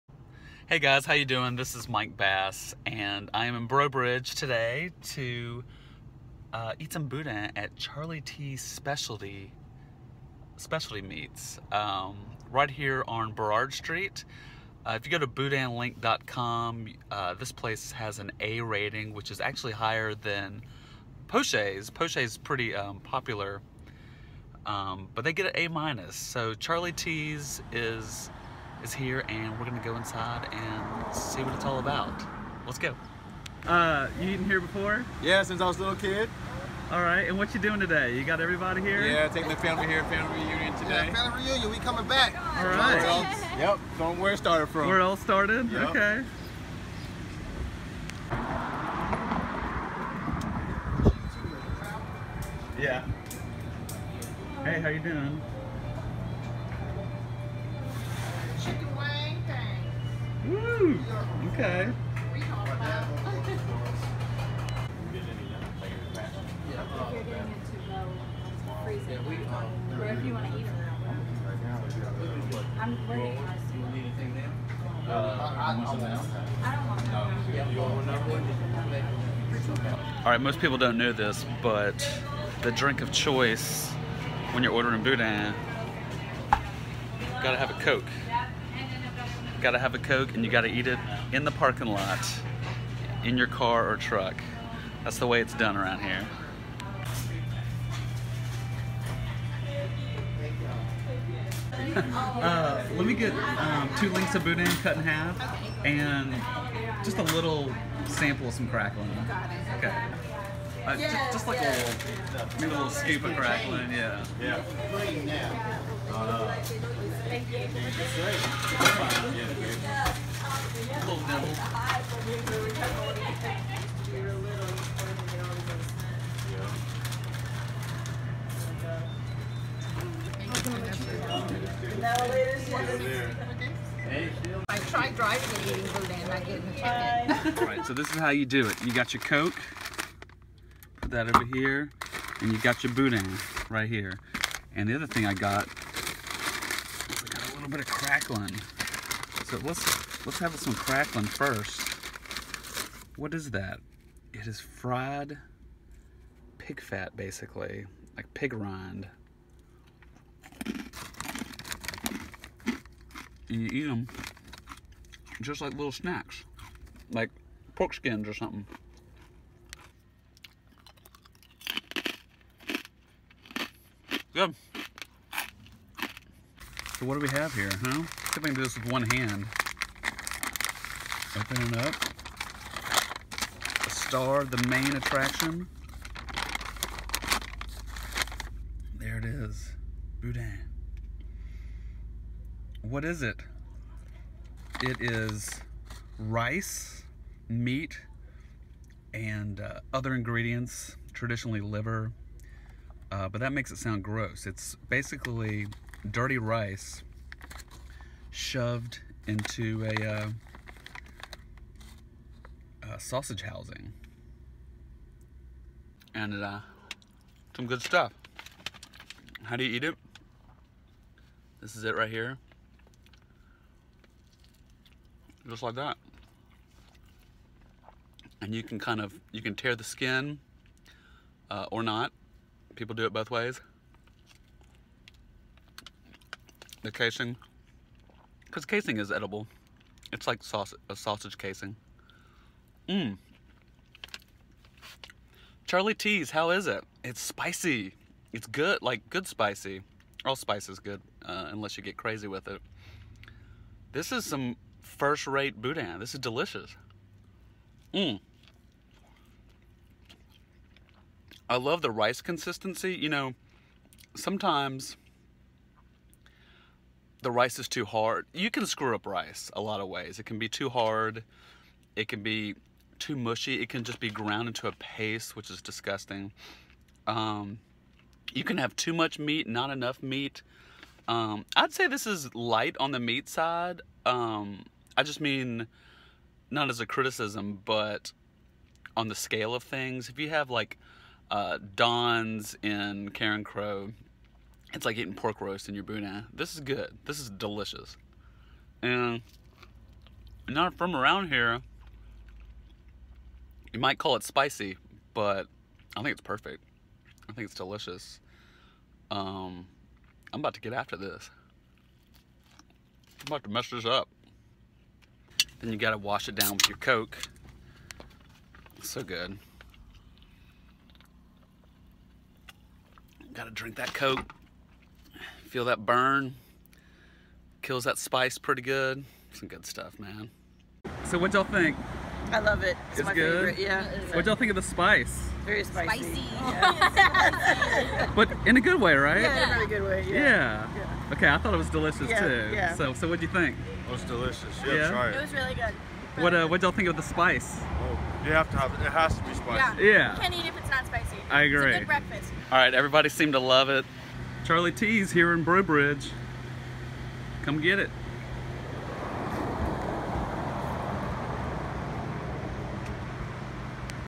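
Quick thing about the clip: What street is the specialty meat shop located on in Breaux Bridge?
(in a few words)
Berard Street.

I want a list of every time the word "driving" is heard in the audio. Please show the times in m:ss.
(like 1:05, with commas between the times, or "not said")
2:15.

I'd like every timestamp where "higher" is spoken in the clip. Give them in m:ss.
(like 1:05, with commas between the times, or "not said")
0:19.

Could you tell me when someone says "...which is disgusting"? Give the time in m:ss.
4:35.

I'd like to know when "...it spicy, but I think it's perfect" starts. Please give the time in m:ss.
5:04.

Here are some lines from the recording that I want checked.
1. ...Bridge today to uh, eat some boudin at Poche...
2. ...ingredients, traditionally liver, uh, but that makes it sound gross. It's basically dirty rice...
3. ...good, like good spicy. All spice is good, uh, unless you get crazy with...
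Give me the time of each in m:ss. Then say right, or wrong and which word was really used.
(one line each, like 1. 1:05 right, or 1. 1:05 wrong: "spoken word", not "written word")
1. 0:03 wrong: "Charlie", not "Poche"
2. 3:20 right
3. 4:08 right.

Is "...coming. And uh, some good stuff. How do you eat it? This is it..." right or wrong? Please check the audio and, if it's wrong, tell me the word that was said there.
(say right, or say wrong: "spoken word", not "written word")
wrong: "housing", not "coming".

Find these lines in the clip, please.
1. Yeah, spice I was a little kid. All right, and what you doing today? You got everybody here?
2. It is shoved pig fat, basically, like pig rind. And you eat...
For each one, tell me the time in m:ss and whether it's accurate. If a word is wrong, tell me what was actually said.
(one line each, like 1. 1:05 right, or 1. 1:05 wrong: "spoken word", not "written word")
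1. 0:35 wrong: "since", not "spice"
2. 2:34 wrong: "fried", not "shoved".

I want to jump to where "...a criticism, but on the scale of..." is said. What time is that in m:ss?
4:46.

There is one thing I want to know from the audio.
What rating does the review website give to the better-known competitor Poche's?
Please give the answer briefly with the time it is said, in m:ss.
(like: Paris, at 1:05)
A minus, at 0:25.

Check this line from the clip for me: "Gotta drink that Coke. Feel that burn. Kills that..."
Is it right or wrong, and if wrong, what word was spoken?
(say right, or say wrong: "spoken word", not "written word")
right.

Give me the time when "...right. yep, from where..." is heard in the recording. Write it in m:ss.
0:42.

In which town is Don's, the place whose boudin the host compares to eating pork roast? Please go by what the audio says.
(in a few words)
Carencro.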